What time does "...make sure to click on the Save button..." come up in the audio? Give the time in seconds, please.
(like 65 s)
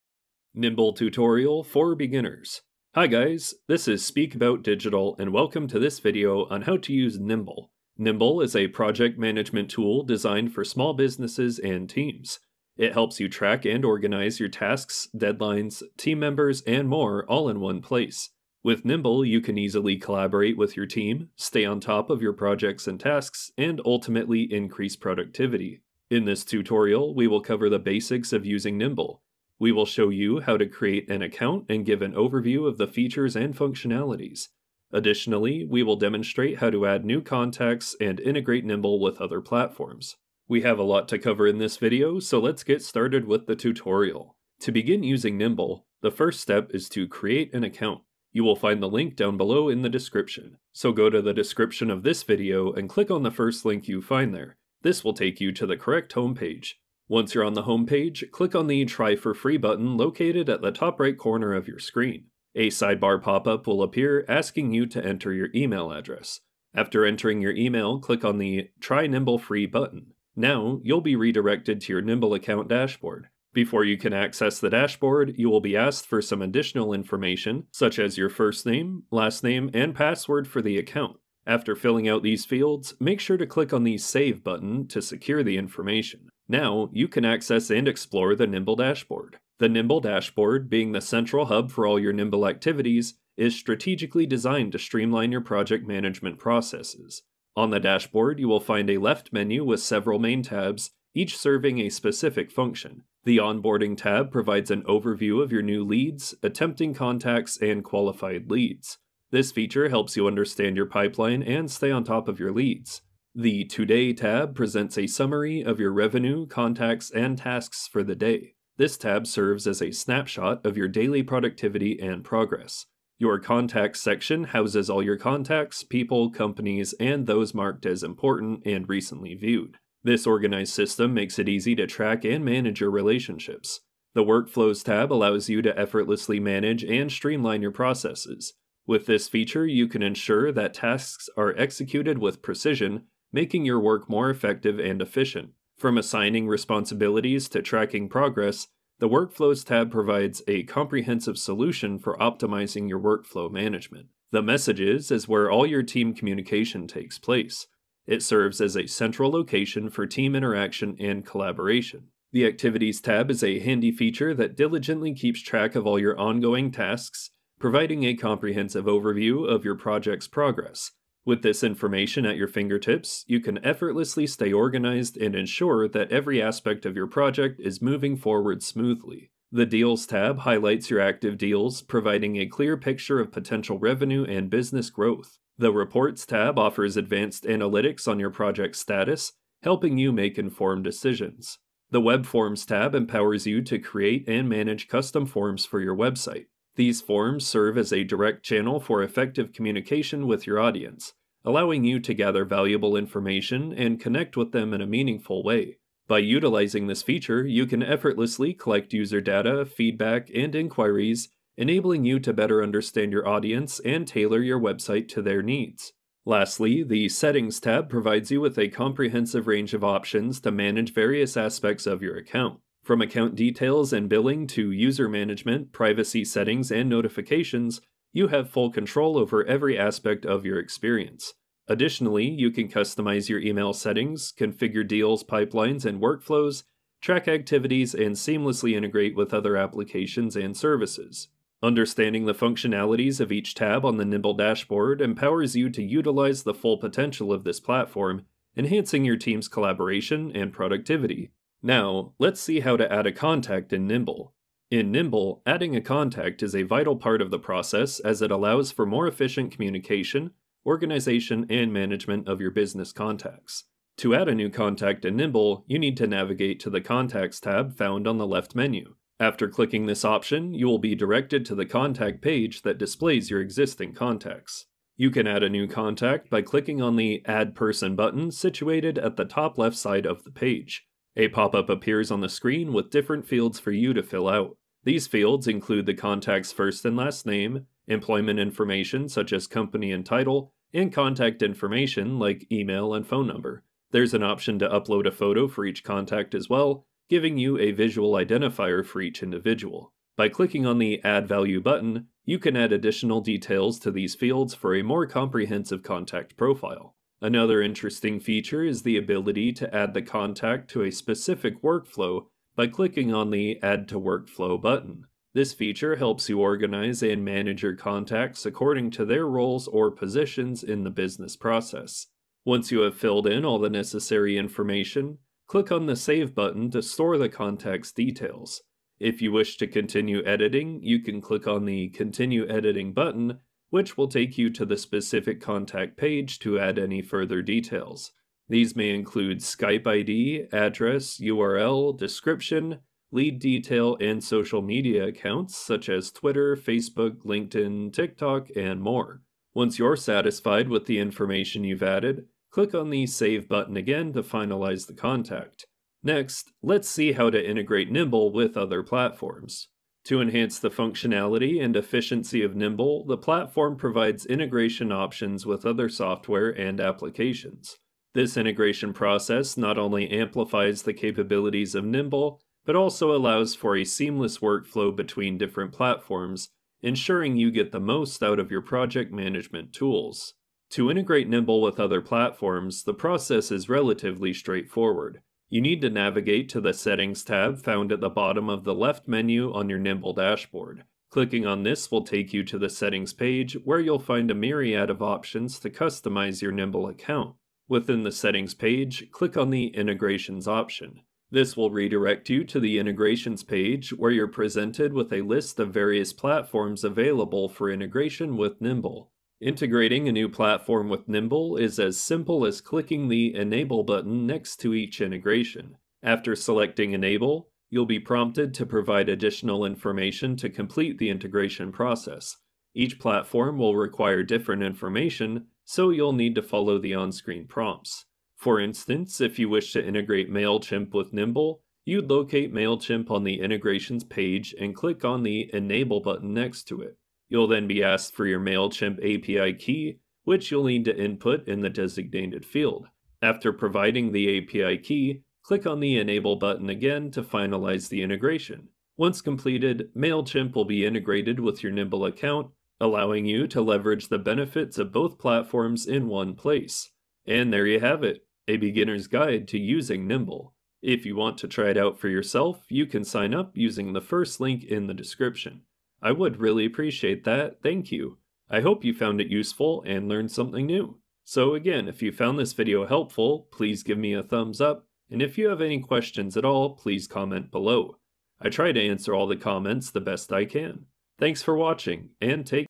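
83 s.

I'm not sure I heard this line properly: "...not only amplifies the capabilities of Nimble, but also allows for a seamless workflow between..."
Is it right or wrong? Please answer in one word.
right.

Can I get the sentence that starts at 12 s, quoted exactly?
It helps you track and organize your tasks, deadlines, team members, and more all in one place.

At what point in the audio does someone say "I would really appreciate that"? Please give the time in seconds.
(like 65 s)
466 s.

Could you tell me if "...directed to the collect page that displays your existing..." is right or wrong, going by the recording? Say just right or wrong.
wrong.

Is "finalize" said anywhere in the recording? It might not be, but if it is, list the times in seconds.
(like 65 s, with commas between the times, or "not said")
354 s, 447 s.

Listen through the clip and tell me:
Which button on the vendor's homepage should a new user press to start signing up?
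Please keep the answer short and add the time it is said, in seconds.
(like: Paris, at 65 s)
Try for Free, at 58 s.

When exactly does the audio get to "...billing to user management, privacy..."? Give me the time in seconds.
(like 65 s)
224 s.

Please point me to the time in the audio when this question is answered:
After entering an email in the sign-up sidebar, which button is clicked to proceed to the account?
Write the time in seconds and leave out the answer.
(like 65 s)
68 s.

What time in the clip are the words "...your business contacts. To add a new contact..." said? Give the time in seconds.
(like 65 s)
262 s.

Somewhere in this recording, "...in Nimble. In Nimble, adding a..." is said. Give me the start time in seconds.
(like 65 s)
253 s.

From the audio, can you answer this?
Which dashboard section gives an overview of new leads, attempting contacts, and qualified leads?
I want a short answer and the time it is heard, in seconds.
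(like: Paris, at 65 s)
Onboarding, at 103 s.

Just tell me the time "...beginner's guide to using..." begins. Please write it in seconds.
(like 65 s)
458 s.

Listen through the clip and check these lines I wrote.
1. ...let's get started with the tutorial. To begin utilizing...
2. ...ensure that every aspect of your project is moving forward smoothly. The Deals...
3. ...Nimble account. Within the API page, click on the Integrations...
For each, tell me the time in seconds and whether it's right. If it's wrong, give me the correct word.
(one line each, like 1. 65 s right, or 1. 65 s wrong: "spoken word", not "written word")
1. 42 s wrong: "using", not "utilizing"
2. 175 s right
3. 396 s wrong: "Settings", not "API".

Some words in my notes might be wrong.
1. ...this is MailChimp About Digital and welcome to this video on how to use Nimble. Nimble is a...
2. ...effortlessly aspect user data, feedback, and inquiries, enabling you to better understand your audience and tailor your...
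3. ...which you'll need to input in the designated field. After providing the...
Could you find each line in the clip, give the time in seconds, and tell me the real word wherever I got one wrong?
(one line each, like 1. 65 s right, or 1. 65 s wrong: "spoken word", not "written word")
1. 3 s wrong: "Speak", not "MailChimp"
2. 207 s wrong: "collect", not "aspect"
3. 440 s right.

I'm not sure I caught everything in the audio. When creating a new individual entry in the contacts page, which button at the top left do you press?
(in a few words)
Add Person.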